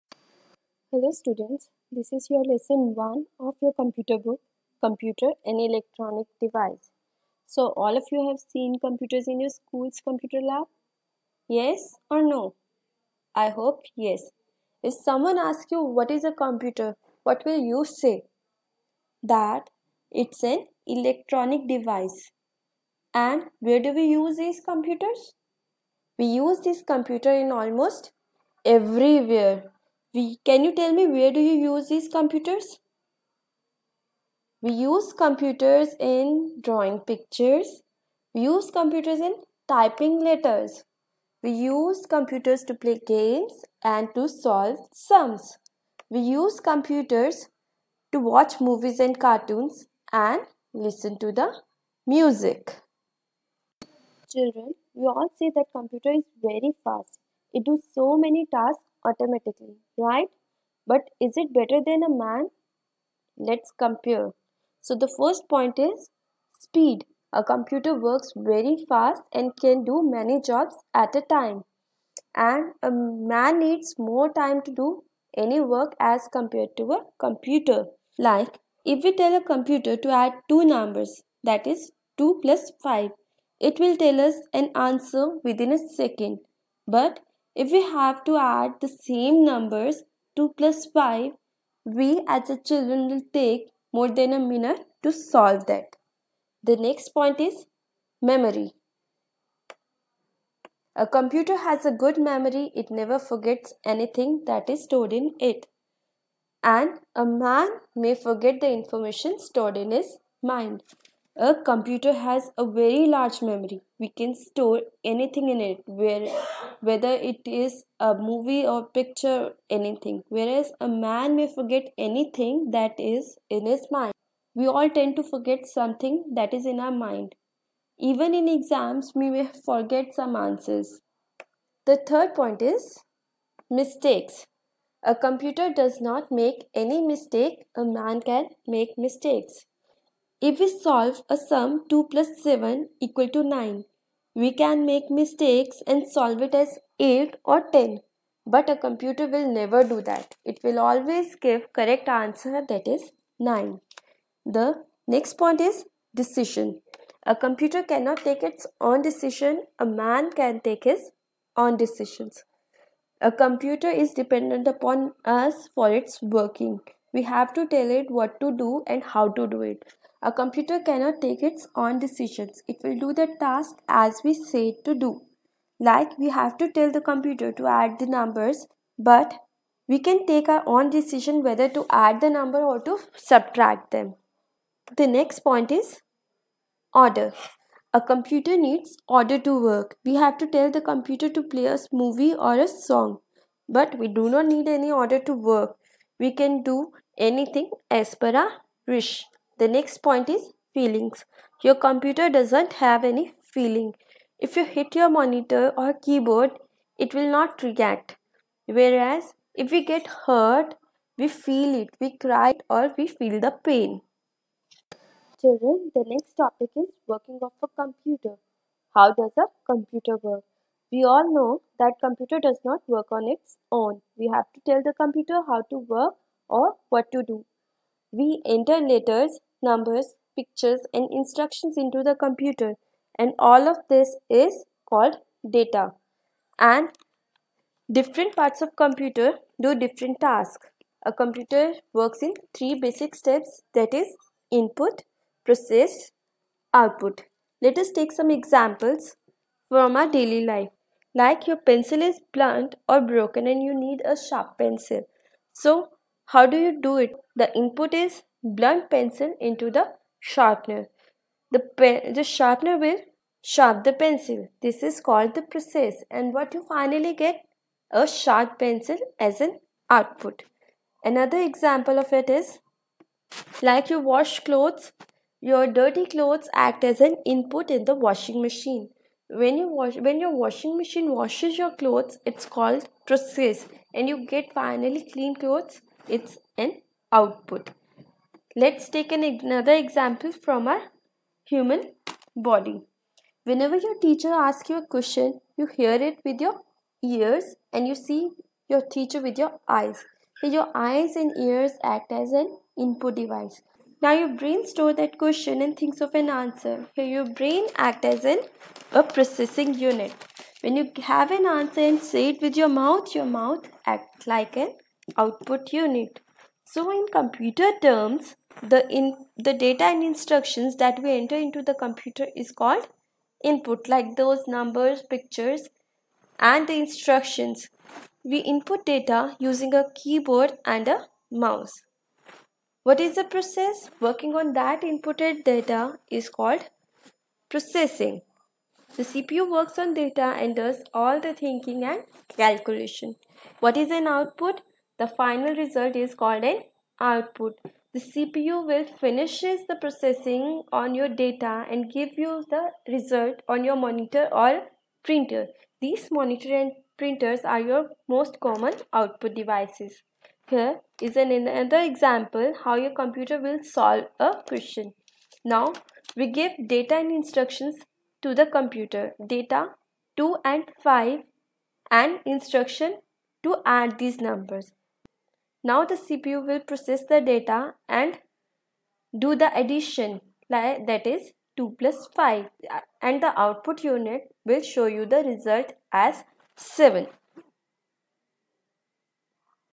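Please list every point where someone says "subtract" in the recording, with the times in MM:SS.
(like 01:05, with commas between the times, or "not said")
03:03.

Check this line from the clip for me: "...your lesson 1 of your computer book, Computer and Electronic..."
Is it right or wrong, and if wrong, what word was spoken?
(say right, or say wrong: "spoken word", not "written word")
right.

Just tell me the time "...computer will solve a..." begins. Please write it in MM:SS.
06:03.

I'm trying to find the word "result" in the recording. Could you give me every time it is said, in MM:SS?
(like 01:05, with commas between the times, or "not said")
05:45, 05:52, 06:25.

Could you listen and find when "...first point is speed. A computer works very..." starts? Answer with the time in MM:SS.
01:05.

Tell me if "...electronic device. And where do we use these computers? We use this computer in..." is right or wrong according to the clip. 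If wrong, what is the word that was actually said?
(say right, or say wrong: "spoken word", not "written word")
right.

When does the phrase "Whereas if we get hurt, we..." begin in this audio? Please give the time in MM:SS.
03:28.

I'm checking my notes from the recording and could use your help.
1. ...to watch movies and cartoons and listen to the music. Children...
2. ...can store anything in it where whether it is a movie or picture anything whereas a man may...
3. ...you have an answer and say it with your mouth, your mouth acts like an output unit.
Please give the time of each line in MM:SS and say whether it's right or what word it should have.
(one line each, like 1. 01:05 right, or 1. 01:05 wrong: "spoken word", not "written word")
1. 00:48 right
2. 01:54 right
3. 05:10 right.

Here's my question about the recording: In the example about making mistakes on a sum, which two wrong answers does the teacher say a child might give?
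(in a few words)
8 or 10.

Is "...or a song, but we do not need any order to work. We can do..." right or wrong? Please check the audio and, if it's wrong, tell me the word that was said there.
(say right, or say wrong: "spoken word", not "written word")
right.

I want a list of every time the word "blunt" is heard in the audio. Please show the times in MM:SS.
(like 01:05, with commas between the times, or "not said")
04:12, 04:18.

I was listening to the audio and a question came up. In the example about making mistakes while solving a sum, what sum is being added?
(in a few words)
2 plus 7.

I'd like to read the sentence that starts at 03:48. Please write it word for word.
We enter letters numbers, pictures and instructions into the computer and all of this is called data.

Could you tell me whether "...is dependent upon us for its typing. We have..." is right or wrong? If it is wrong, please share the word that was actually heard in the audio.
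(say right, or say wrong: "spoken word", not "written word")
wrong: "working", not "typing".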